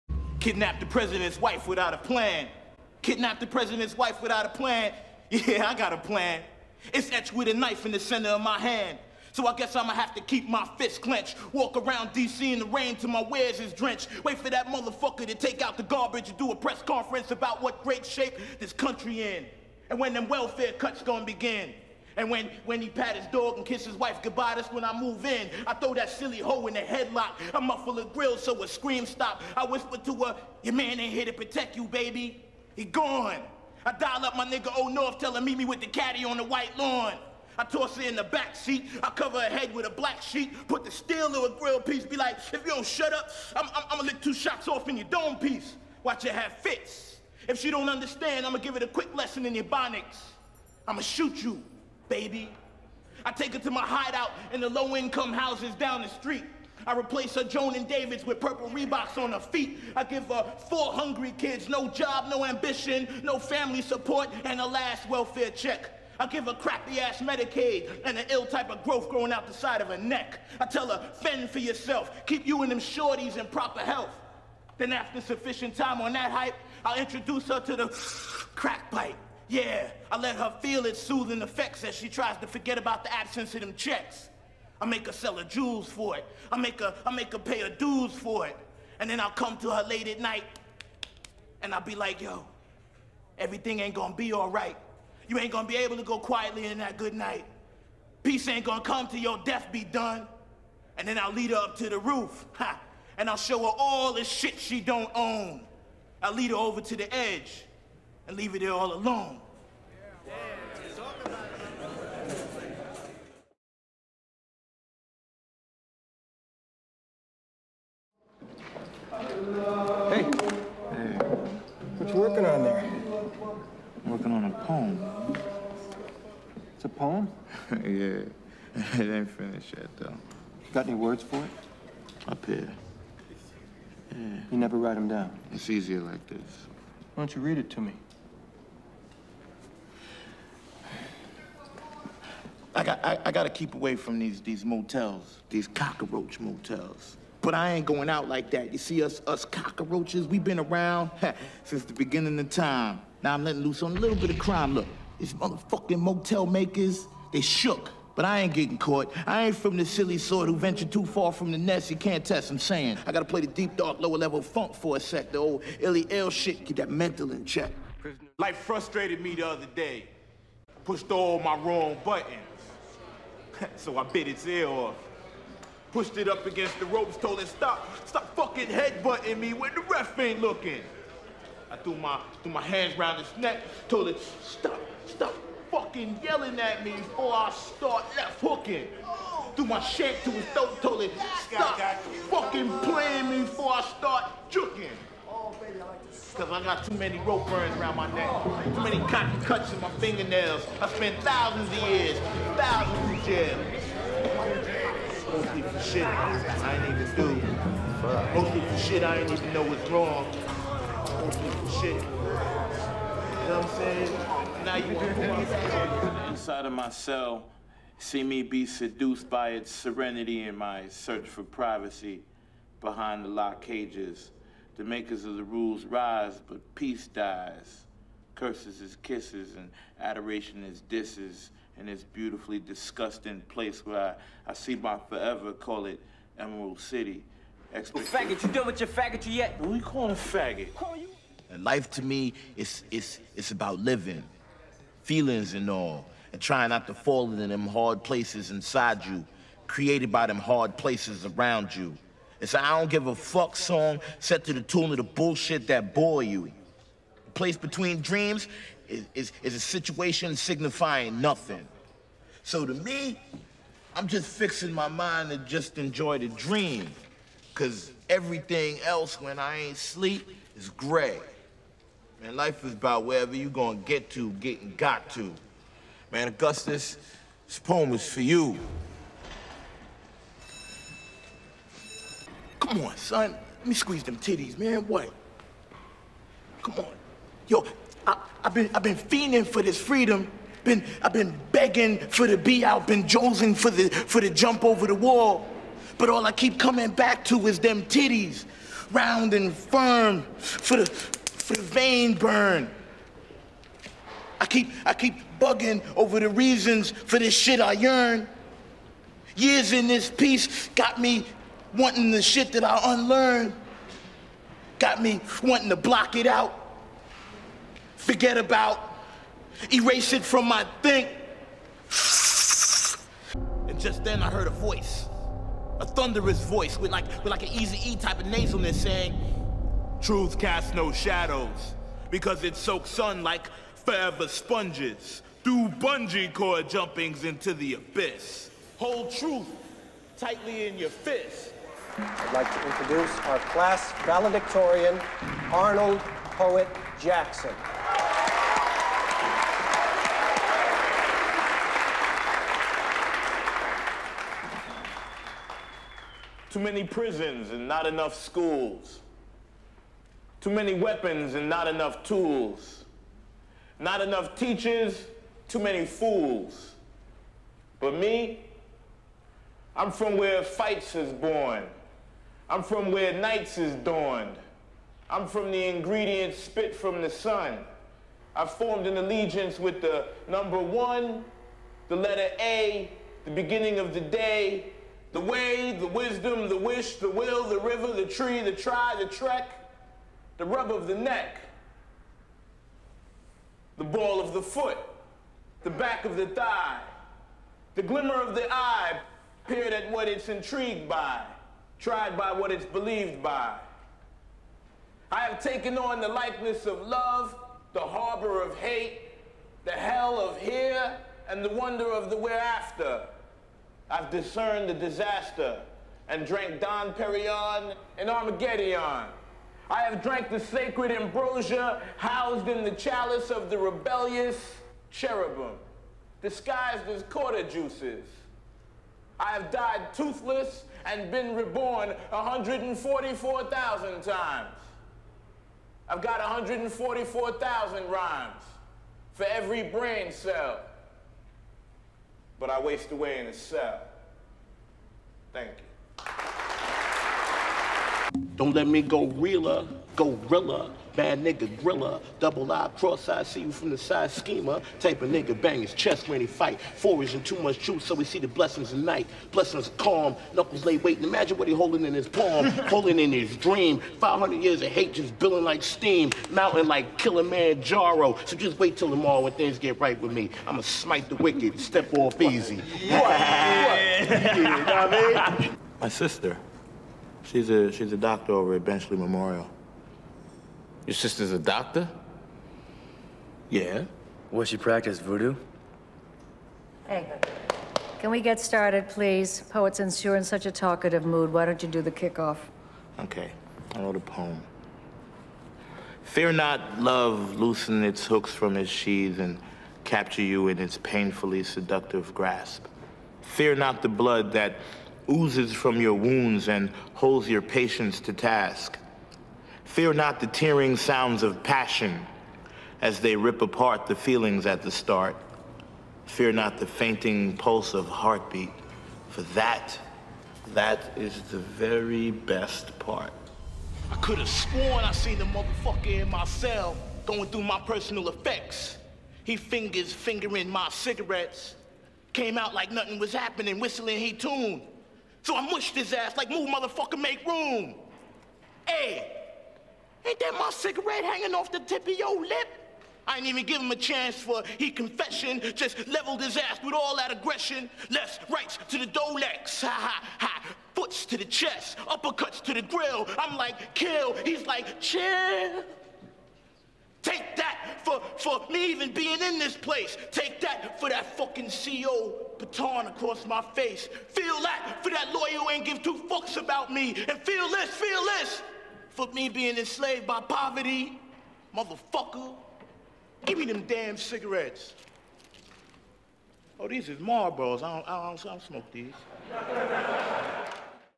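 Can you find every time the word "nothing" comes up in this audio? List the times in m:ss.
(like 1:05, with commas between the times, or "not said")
4:21, 8:52.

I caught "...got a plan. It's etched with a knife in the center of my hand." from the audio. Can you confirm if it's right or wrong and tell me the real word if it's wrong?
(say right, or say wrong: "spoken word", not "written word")
right.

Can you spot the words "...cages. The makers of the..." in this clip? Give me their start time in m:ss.
3:43.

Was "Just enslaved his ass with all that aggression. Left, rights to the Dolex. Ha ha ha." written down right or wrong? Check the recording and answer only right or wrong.
wrong.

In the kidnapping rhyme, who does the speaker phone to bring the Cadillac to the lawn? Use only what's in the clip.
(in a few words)
Old North.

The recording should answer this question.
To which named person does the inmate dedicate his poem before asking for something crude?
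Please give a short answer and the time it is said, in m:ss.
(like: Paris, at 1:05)
Augustus, at 4:36.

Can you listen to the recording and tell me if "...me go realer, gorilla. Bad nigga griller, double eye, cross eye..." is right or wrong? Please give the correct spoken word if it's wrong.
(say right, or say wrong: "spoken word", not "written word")
right.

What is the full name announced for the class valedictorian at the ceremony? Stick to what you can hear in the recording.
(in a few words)
Arnold Poet Jackson.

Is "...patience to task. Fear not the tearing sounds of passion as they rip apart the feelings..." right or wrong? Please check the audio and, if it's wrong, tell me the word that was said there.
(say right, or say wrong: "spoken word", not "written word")
right.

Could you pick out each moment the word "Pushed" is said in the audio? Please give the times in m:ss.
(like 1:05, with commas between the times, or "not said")
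2:50, 2:55.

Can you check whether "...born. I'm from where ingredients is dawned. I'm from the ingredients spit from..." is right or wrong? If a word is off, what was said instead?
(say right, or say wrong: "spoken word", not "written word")
wrong: "nights", not "ingredients".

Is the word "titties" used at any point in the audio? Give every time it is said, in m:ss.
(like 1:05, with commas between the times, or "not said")
4:44, 4:57.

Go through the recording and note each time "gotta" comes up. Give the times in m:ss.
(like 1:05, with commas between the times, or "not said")
2:23, 2:43.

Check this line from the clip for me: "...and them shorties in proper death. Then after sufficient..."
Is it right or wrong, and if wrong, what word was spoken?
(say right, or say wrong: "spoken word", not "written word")
wrong: "health", not "death".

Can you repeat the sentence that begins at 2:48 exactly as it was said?
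Life frustrated me the other day.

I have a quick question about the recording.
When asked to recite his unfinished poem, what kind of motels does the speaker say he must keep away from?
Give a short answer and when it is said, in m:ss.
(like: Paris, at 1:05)
Cockroach motels, at 2:25.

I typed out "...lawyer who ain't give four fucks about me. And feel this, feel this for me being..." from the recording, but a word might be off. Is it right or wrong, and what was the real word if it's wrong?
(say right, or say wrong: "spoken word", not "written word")
wrong: "two", not "four".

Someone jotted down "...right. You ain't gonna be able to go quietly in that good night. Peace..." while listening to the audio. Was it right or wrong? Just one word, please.
right.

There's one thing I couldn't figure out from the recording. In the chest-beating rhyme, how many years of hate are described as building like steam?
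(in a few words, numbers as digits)
500.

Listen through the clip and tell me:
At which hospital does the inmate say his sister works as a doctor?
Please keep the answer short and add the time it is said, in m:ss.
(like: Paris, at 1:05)
Benchley Memorial, at 7:58.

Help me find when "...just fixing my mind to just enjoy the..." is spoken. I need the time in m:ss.
4:24.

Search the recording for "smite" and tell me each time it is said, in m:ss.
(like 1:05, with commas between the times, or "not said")
7:50.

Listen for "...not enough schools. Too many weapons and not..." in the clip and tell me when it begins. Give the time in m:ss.
5:57.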